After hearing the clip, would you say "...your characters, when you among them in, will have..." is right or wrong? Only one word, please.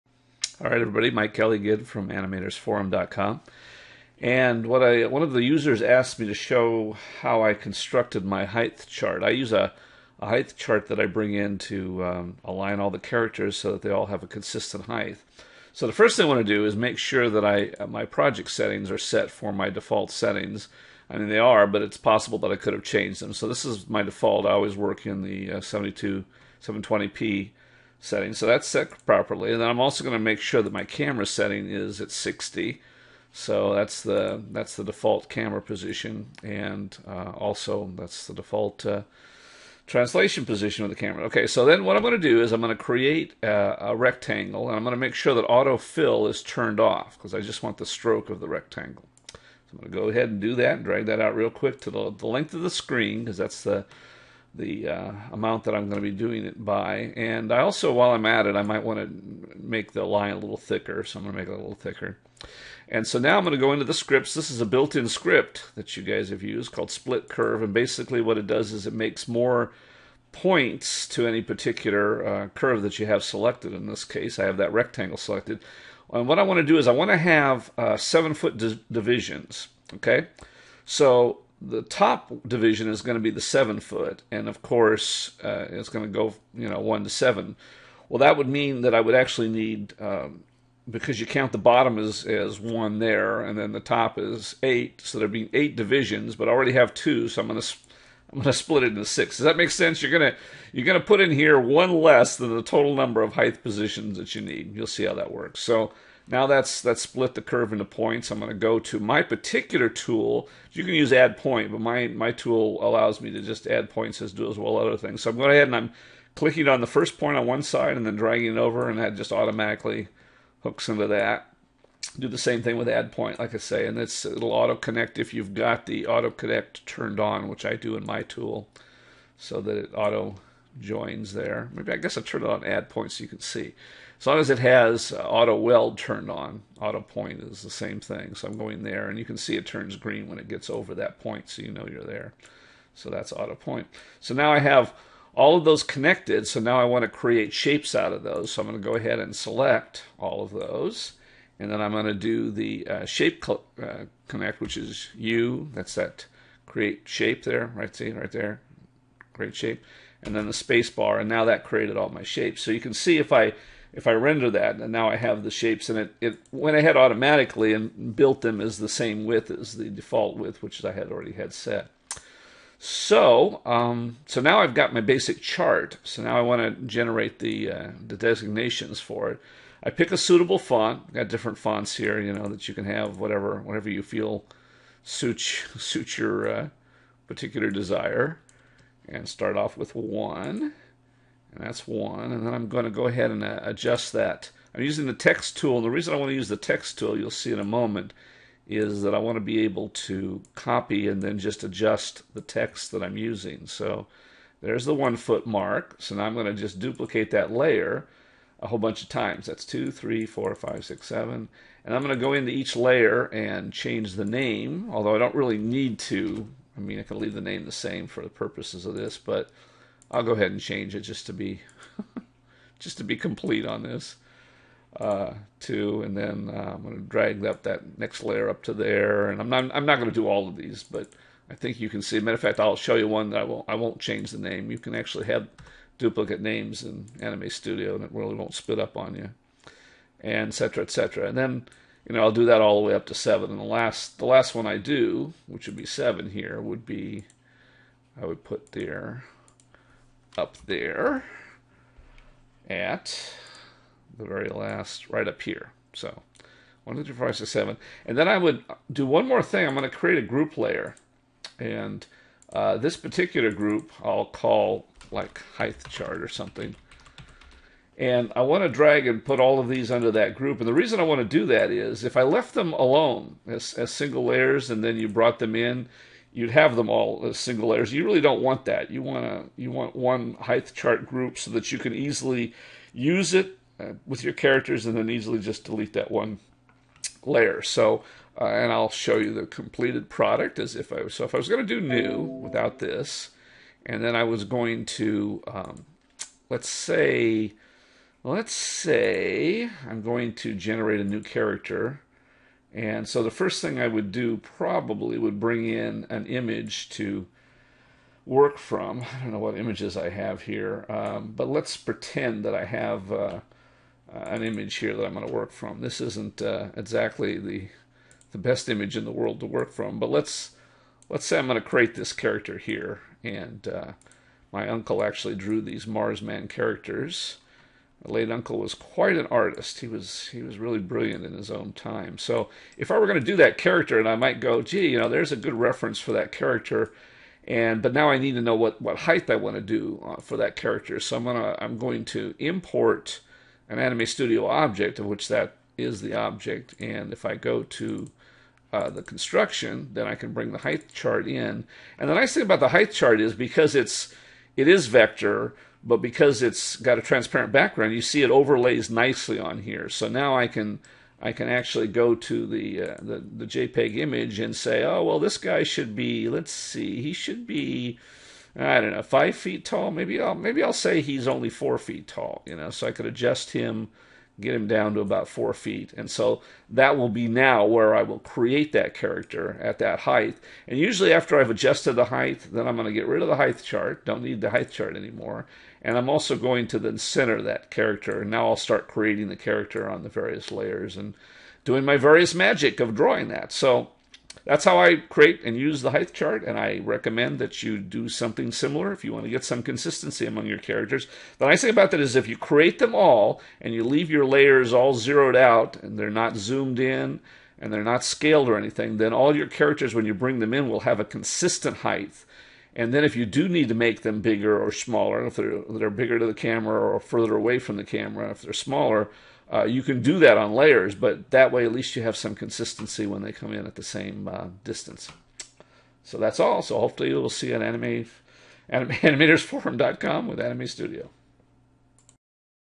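wrong.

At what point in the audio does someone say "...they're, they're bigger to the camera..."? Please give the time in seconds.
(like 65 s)
415 s.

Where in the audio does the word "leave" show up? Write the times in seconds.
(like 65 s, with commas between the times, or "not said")
217 s, 403 s.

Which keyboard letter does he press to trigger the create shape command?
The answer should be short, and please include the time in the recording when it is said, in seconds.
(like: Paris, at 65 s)
U, at 155 s.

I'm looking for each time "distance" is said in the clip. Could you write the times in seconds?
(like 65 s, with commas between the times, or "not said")
424 s.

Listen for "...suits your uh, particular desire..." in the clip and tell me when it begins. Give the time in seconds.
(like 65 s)
185 s.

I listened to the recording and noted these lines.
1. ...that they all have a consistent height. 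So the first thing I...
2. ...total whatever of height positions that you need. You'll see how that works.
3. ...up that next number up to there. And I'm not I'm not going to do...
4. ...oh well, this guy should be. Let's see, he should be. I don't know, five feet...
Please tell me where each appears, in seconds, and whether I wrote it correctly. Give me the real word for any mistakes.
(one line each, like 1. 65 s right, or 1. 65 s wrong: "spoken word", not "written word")
1. 13 s right
2. 102 s wrong: "number", not "whatever"
3. 227 s wrong: "layer", not "number"
4. 364 s right.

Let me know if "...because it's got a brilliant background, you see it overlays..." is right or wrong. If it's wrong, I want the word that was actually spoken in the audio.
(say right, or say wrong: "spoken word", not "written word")
wrong: "transparent", not "brilliant".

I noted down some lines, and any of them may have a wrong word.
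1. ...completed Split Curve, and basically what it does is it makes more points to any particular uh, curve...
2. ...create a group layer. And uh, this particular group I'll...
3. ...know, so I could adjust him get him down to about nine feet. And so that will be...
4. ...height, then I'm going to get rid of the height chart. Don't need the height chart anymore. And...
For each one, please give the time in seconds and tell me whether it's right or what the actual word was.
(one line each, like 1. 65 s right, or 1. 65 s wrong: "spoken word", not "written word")
1. 66 s wrong: "called", not "completed"
2. 259 s right
3. 372 s wrong: "four", not "nine"
4. 382 s right.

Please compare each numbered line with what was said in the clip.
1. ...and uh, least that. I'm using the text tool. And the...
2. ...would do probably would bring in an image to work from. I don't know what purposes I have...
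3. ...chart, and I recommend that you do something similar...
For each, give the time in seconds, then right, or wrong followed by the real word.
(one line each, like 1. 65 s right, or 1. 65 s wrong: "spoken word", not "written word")
1. 193 s wrong: "adjust", not "least"
2. 303 s wrong: "images", not "purposes"
3. 396 s right.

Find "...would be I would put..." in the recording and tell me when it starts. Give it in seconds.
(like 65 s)
246 s.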